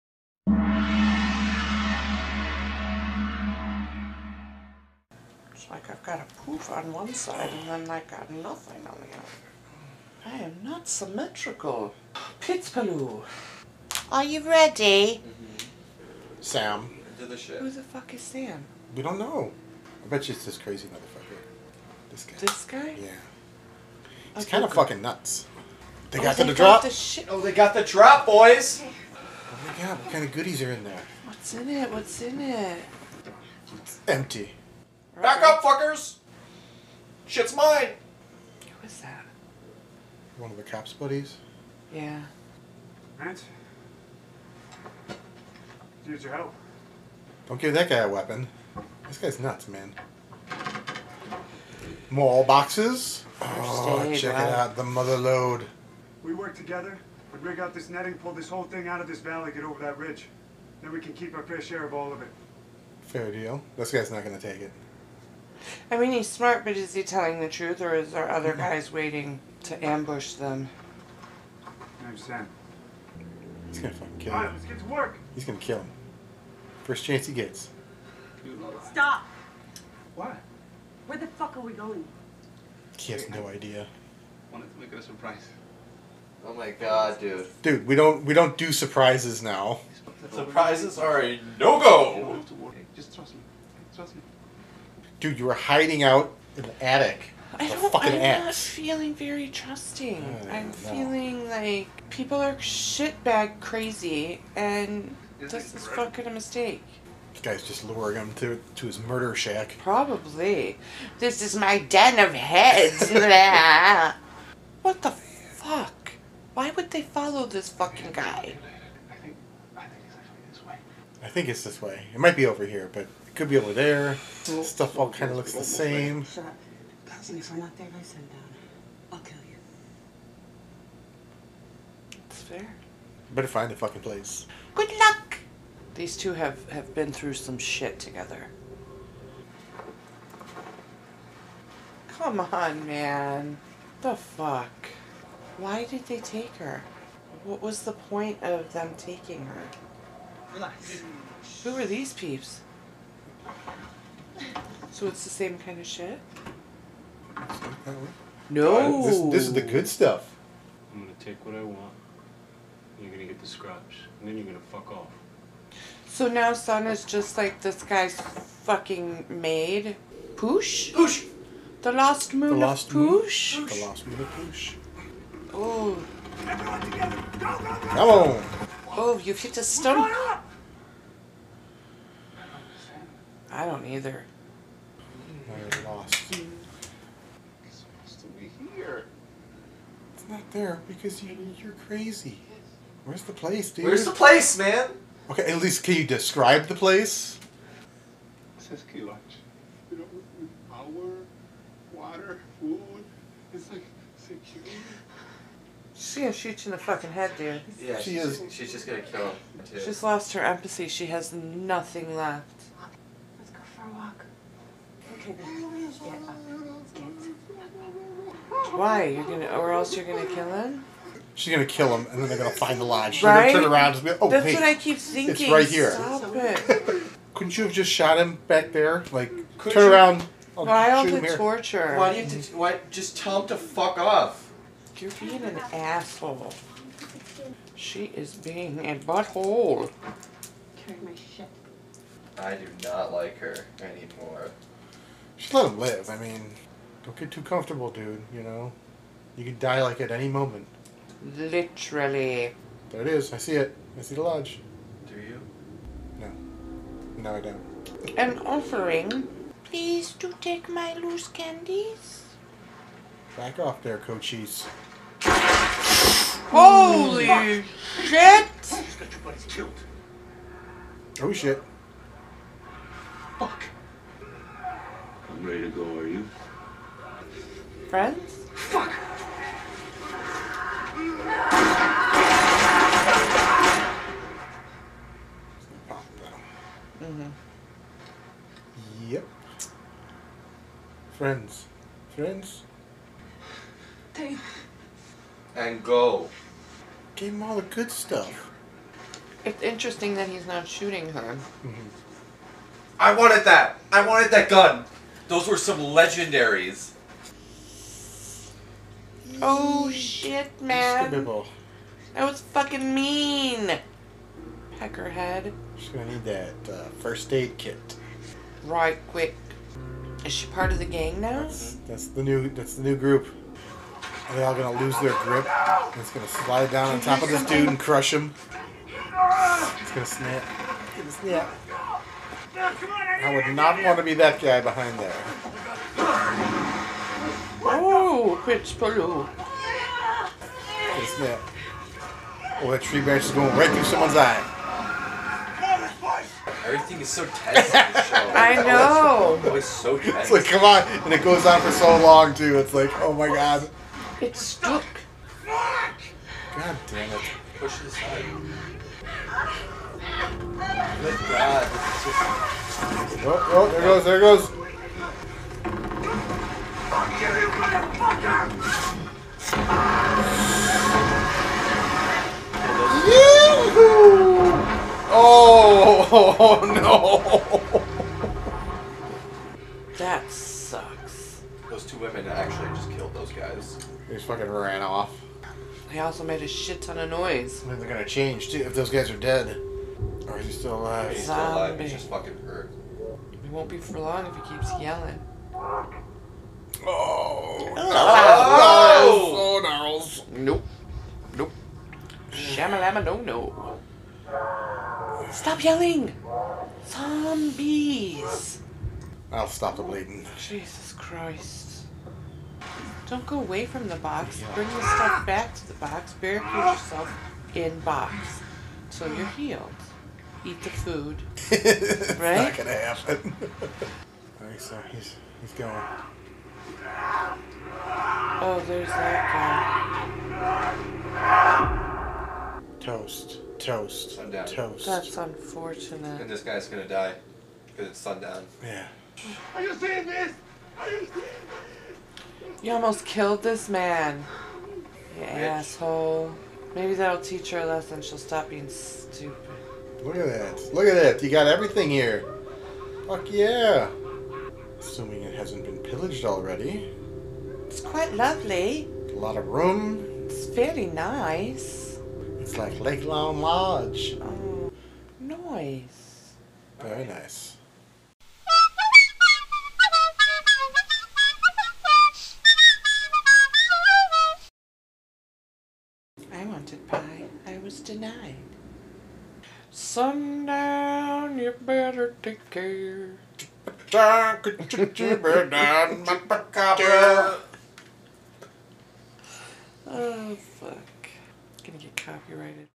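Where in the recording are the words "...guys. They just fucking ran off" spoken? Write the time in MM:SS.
06:23.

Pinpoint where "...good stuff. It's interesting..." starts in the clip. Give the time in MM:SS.
04:57.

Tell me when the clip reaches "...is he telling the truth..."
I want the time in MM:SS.
01:06.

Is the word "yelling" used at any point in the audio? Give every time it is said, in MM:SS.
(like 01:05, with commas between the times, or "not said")
06:34, 06:45.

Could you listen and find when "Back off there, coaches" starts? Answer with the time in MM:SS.
04:23.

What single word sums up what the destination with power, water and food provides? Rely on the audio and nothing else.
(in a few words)
Security.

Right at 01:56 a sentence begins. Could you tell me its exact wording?
Why would they follow this fucking guy?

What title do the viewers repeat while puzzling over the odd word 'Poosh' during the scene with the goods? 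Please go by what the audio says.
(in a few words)
The Lost Moon of Poosh.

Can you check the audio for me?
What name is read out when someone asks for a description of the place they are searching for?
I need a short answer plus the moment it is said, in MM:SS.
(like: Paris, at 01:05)
Kielach, at 03:18.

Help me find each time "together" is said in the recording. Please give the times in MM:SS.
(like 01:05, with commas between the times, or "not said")
00:56, 02:17, 02:56.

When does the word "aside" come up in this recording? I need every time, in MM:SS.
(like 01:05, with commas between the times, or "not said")
05:57.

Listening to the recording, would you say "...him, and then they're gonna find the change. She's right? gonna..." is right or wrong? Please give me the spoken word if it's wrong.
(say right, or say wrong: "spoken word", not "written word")
wrong: "lodge", not "change".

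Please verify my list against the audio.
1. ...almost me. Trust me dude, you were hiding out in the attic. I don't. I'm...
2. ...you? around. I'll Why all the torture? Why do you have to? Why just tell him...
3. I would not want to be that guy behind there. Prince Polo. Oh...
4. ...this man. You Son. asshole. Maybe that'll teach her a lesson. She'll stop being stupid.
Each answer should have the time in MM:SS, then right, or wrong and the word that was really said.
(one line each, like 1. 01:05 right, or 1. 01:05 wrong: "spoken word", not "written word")
1. 01:33 wrong: "trust", not "almost"
2. 03:49 right
3. 05:33 right
4. 07:23 wrong: "Bitch", not "Son".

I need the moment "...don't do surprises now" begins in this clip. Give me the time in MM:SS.
01:28.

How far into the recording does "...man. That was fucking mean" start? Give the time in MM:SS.
05:10.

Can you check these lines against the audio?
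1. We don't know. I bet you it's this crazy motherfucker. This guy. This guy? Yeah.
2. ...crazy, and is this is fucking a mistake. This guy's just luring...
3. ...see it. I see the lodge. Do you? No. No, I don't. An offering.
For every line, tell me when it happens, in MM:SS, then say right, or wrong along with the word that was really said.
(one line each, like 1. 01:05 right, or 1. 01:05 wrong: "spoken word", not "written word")
1. 00:18 right
2. 01:43 right
3. 04:13 right.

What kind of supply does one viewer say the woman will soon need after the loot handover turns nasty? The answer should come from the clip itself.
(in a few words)
First aid kit.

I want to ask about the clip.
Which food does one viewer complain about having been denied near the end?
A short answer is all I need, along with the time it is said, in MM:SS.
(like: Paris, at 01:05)
Pie, at 07:56.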